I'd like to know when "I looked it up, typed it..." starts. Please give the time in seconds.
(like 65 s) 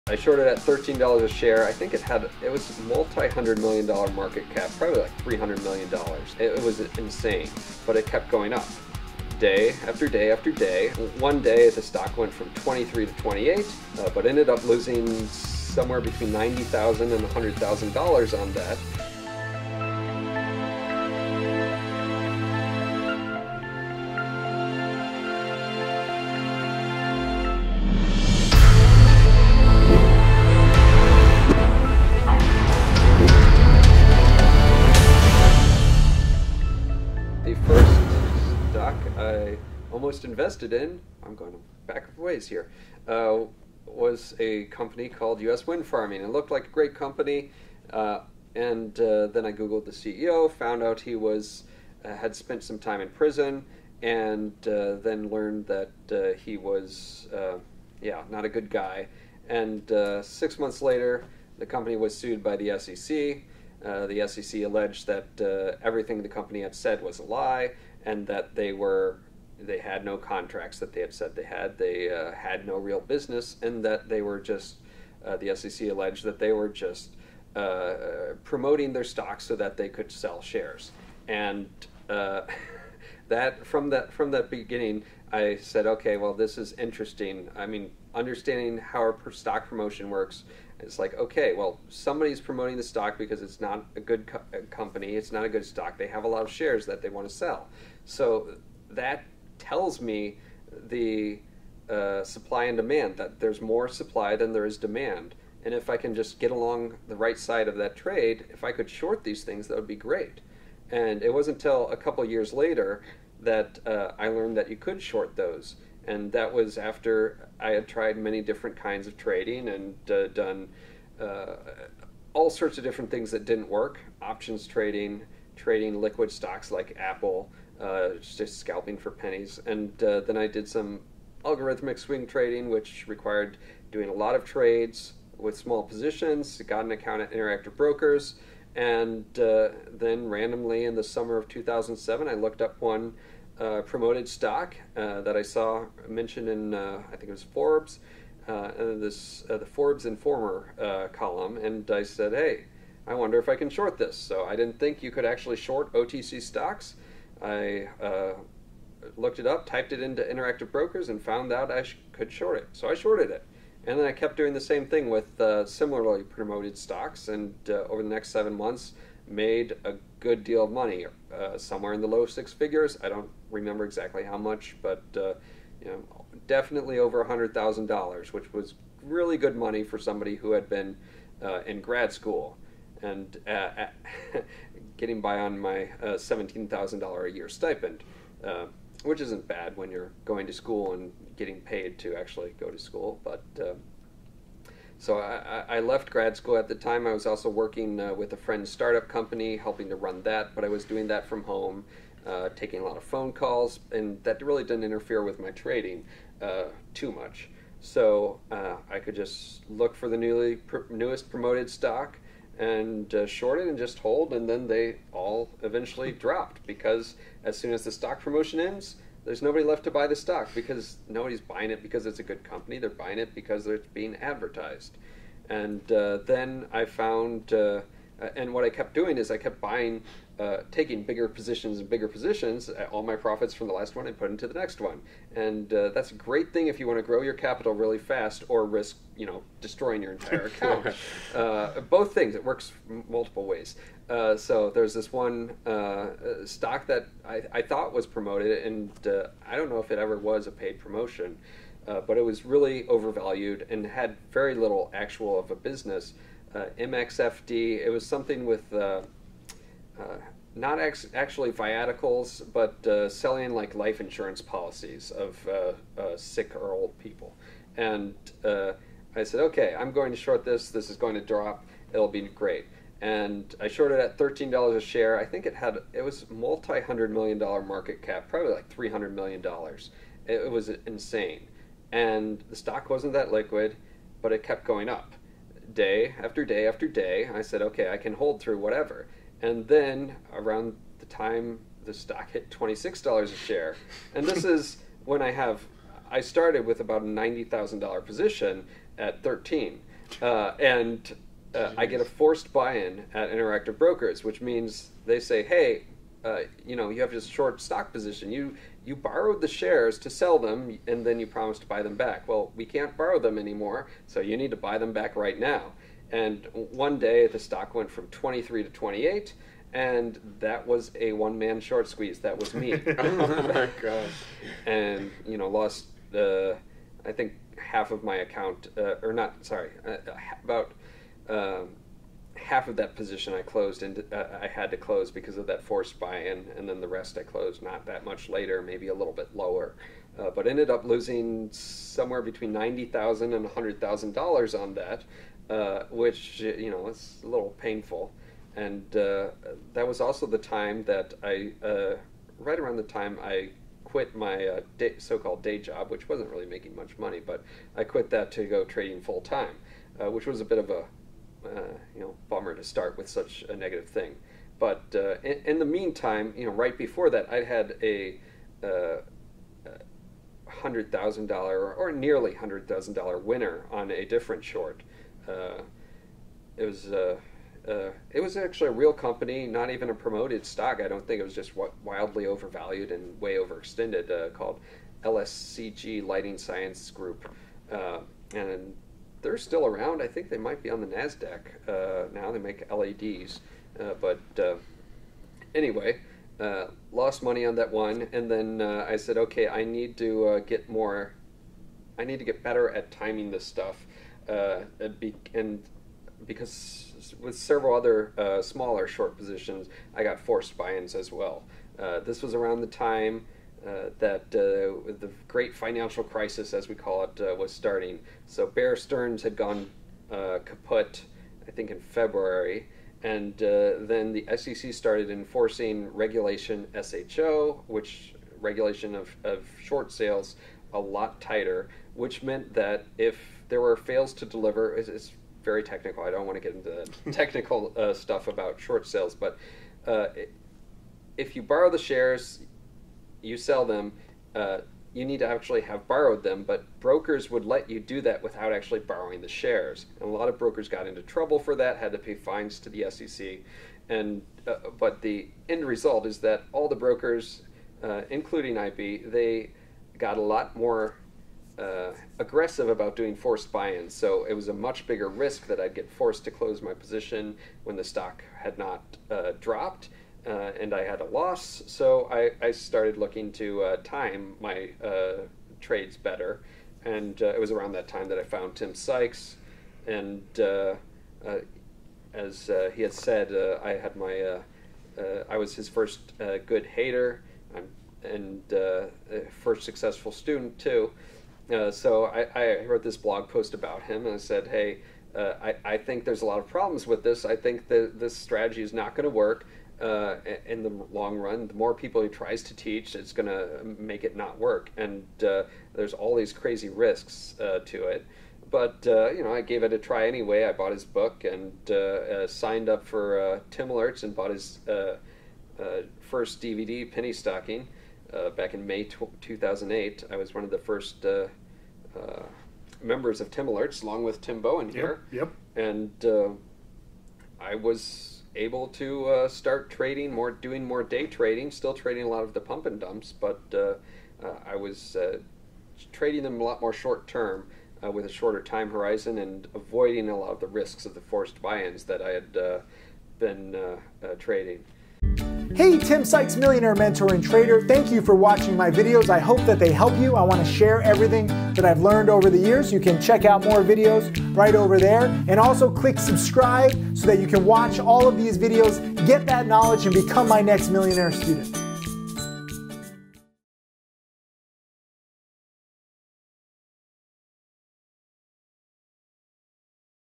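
157 s.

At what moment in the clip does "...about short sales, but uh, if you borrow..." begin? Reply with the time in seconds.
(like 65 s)
438 s.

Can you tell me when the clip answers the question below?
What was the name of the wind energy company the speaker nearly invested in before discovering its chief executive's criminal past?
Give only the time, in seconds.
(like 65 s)
45 s.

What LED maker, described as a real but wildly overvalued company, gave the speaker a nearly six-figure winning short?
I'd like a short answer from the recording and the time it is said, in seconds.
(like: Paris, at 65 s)
Lighting Science Group, at 386 s.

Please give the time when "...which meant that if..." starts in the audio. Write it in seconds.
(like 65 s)
431 s.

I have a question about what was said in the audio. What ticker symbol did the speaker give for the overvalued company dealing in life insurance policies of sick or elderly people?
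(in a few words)
MXFD.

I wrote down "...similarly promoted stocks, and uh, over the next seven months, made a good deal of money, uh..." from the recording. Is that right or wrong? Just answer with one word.
right.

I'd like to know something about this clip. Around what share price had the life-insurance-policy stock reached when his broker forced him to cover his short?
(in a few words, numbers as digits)
$26.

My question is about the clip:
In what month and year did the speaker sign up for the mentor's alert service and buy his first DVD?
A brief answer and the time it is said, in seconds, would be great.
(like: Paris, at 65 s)
May 2008, at 518 s.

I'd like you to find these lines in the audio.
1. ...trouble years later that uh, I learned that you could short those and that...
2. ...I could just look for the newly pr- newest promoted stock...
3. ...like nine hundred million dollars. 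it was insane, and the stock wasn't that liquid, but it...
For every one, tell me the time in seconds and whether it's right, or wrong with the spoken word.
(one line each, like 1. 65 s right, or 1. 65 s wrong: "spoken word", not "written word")
1. 111 s wrong: "couple", not "trouble"
2. 208 s right
3. 278 s wrong: "three", not "nine".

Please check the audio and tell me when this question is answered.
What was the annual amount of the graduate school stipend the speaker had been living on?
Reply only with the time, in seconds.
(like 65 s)
186 s.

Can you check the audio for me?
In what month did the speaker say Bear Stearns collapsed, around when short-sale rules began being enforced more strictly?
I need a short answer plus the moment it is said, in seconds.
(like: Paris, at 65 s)
February, at 421 s.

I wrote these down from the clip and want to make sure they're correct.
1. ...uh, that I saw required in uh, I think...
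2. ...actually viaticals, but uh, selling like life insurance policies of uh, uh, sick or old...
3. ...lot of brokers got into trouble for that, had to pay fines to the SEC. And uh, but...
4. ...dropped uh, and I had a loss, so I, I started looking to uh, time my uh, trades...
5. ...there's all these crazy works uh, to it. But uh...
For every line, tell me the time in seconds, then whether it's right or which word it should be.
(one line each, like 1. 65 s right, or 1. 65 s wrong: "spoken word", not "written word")
1. 144 s wrong: "mentioned", not "required"
2. 260 s right
3. 450 s right
4. 469 s right
5. 505 s wrong: "risks", not "works".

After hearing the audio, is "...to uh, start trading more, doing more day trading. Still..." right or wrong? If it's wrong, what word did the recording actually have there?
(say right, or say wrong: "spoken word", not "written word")
right.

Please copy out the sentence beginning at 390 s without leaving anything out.
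I think they might be on the NASDAQ uh, now.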